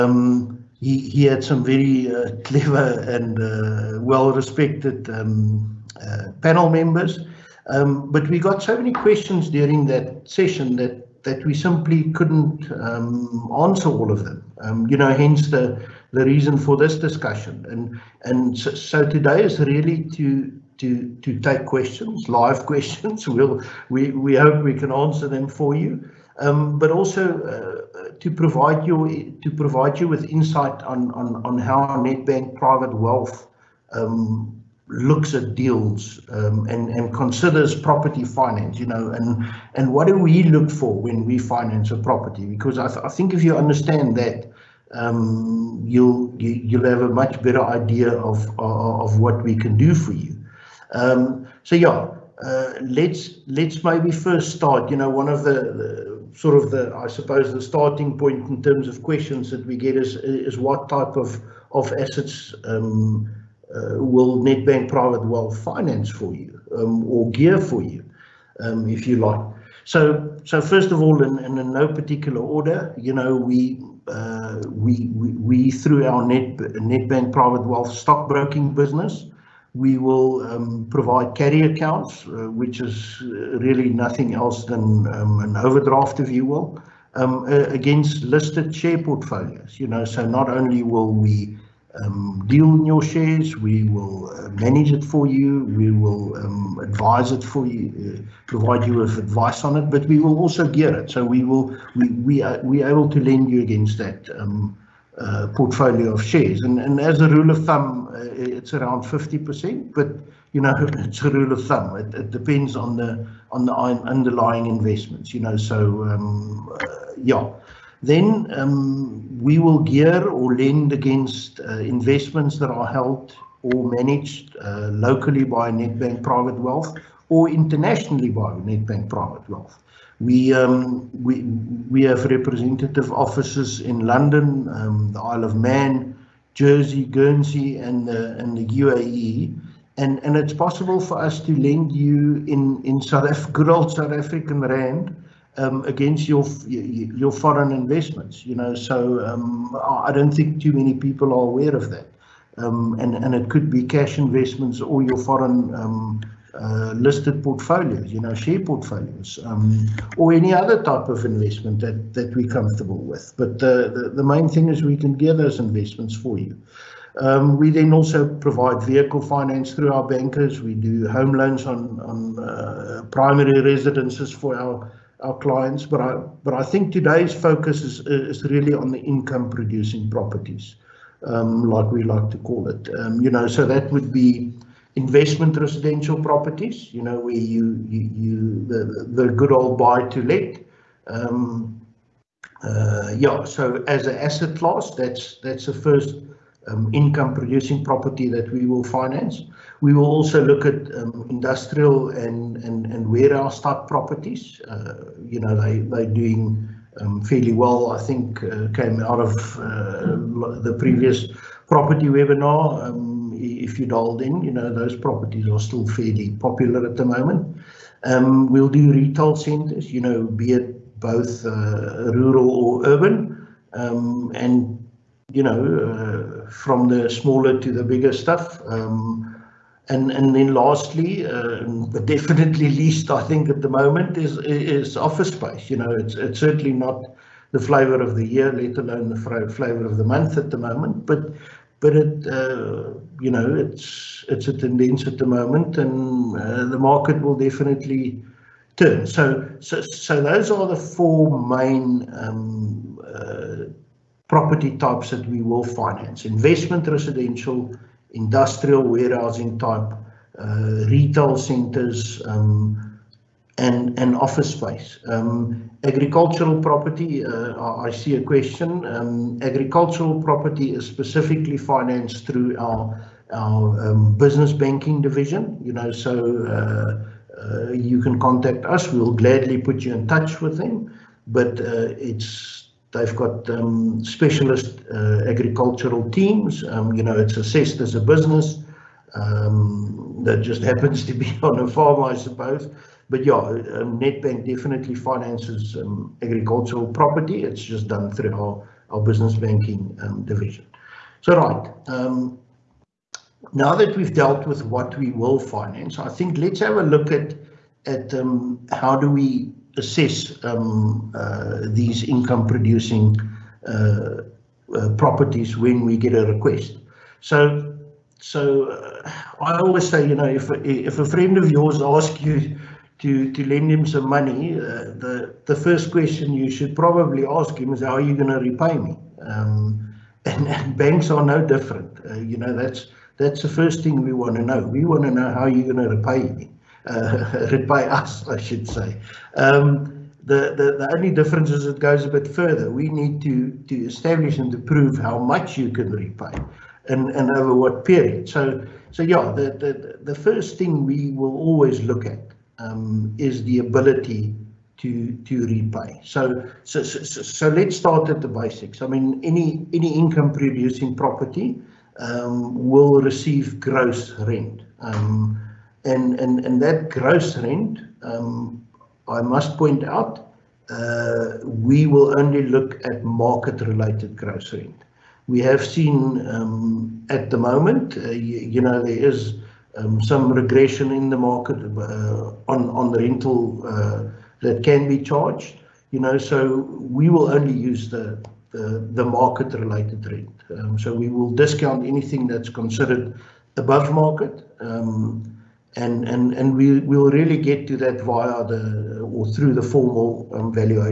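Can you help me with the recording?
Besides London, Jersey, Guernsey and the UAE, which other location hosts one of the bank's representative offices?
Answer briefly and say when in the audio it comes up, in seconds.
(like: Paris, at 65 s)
Isle of Man, at 135 s.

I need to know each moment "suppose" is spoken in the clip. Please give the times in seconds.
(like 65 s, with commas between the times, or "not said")
57 s, 292 s.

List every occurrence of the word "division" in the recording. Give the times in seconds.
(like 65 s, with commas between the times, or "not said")
274 s, 300 s.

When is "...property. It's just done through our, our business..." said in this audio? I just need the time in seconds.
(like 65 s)
296 s.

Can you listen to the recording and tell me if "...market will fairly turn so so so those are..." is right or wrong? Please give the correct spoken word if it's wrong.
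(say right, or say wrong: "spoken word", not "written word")
wrong: "definitely", not "fairly".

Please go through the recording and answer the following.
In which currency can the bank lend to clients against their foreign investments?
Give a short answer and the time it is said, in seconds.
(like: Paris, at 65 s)
South African rand, at 143 s.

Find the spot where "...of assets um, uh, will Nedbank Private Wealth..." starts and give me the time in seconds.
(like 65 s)
61 s.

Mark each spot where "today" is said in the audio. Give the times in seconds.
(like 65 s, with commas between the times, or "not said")
19 s, 176 s.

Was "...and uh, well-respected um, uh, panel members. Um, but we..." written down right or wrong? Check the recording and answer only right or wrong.
right.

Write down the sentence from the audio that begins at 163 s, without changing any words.
But the, the, the main thing is we can gear those investments for you.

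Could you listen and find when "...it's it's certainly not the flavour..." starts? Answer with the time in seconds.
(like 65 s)
235 s.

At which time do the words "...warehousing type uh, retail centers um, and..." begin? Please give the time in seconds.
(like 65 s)
258 s.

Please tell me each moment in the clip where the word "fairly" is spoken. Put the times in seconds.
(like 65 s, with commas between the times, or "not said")
207 s, 215 s.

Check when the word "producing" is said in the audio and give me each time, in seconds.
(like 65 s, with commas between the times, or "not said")
179 s, 197 s, 312 s, 360 s.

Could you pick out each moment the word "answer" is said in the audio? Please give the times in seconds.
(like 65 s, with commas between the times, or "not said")
13 s, 24 s.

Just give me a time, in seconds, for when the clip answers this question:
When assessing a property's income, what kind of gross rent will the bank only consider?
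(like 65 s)
373 s.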